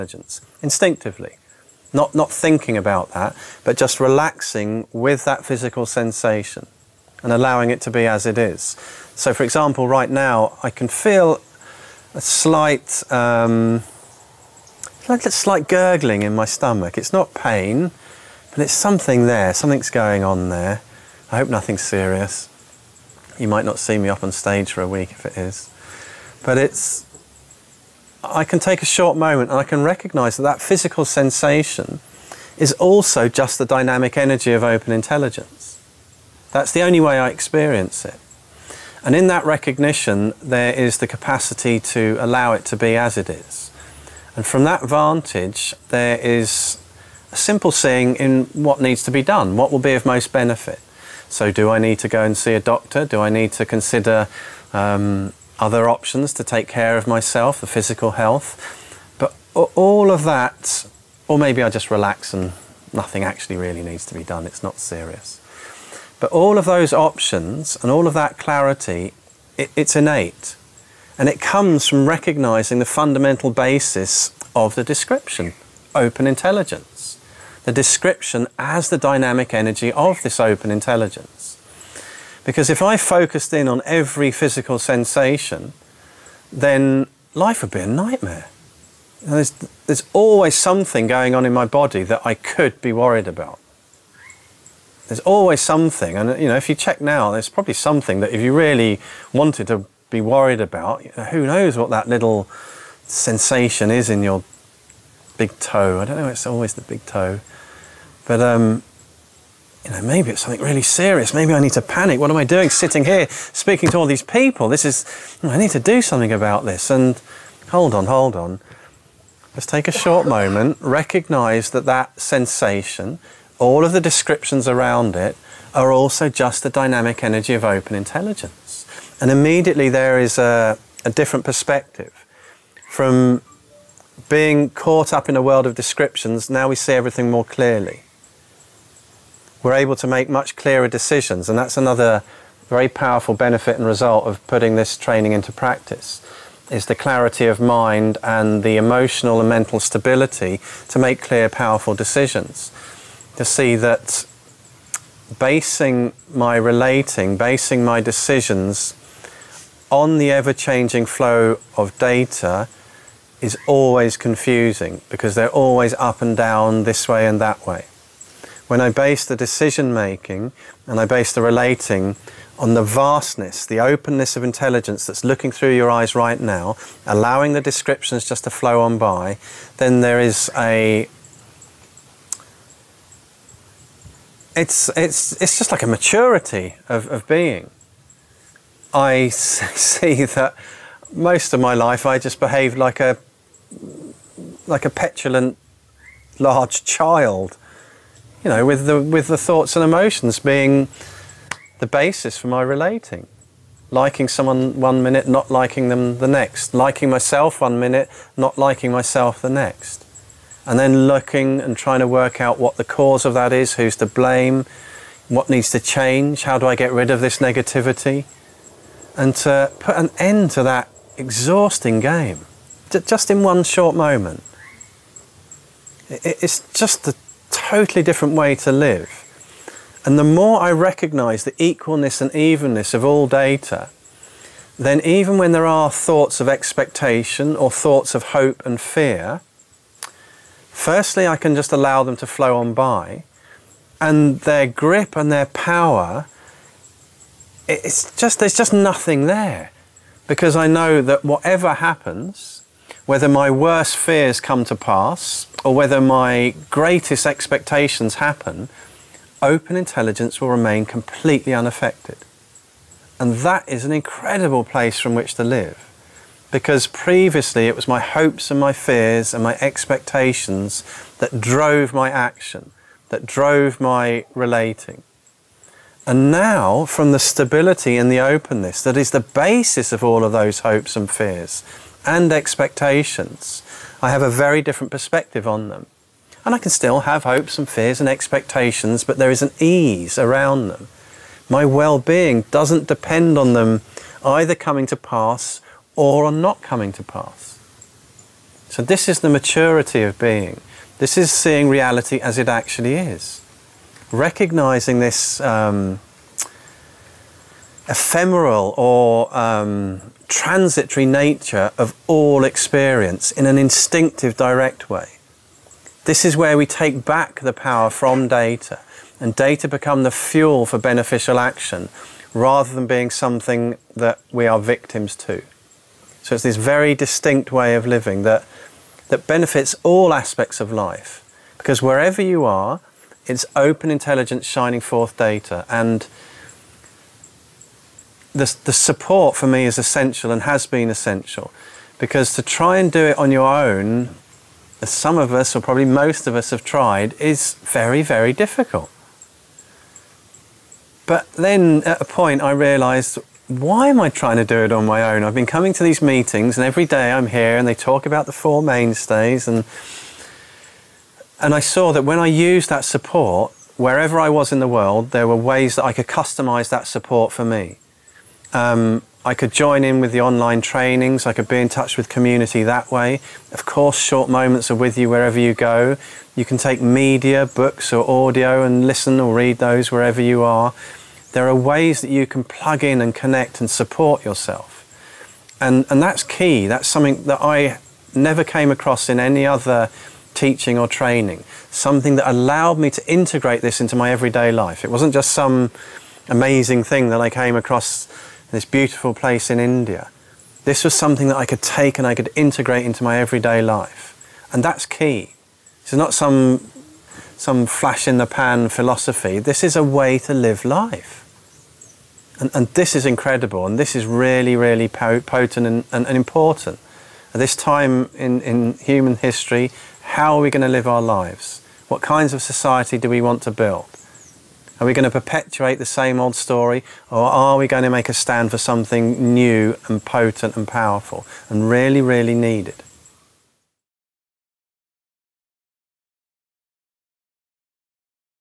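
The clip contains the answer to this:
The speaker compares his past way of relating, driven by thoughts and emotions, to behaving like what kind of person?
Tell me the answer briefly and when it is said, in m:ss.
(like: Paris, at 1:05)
Petulant large child, at 3:14.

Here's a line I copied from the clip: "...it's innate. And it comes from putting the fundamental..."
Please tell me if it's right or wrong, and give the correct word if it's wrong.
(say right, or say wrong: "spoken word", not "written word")
wrong: "recognizing", not "putting".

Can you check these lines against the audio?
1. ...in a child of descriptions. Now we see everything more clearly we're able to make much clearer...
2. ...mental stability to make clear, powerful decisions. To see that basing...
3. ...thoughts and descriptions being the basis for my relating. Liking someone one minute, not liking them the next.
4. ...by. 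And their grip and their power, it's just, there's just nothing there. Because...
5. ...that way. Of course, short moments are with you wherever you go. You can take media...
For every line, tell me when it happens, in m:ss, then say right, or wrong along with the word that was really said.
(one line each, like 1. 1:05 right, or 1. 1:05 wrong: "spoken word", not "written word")
1. 2:15 wrong: "world", not "child"
2. 2:29 right
3. 3:19 wrong: "emotions", not "descriptions"
4. 4:02 right
5. 6:12 right.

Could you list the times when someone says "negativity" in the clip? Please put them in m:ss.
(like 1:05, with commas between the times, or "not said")
3:37.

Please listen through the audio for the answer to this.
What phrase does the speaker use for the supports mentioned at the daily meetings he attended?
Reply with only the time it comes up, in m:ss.
5:58.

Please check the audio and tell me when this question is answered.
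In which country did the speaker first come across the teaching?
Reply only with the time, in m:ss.
6:39.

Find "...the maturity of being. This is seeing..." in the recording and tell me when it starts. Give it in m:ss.
4:59.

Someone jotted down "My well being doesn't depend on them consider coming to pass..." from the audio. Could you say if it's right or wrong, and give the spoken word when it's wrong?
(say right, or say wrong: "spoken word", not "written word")
wrong: "either", not "consider".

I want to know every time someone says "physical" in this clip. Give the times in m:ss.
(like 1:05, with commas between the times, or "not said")
0:05, 0:30, 0:57, 1:24.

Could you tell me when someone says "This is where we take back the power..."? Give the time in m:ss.
5:16.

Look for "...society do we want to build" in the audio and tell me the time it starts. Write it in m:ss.
7:02.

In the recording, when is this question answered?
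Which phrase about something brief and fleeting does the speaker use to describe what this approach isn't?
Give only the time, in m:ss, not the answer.
6:47.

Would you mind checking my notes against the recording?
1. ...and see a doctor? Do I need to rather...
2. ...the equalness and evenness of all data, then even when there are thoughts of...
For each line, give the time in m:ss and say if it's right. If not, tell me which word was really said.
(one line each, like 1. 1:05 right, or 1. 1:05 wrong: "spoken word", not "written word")
1. 0:52 wrong: "consider", not "rather"
2. 3:51 right.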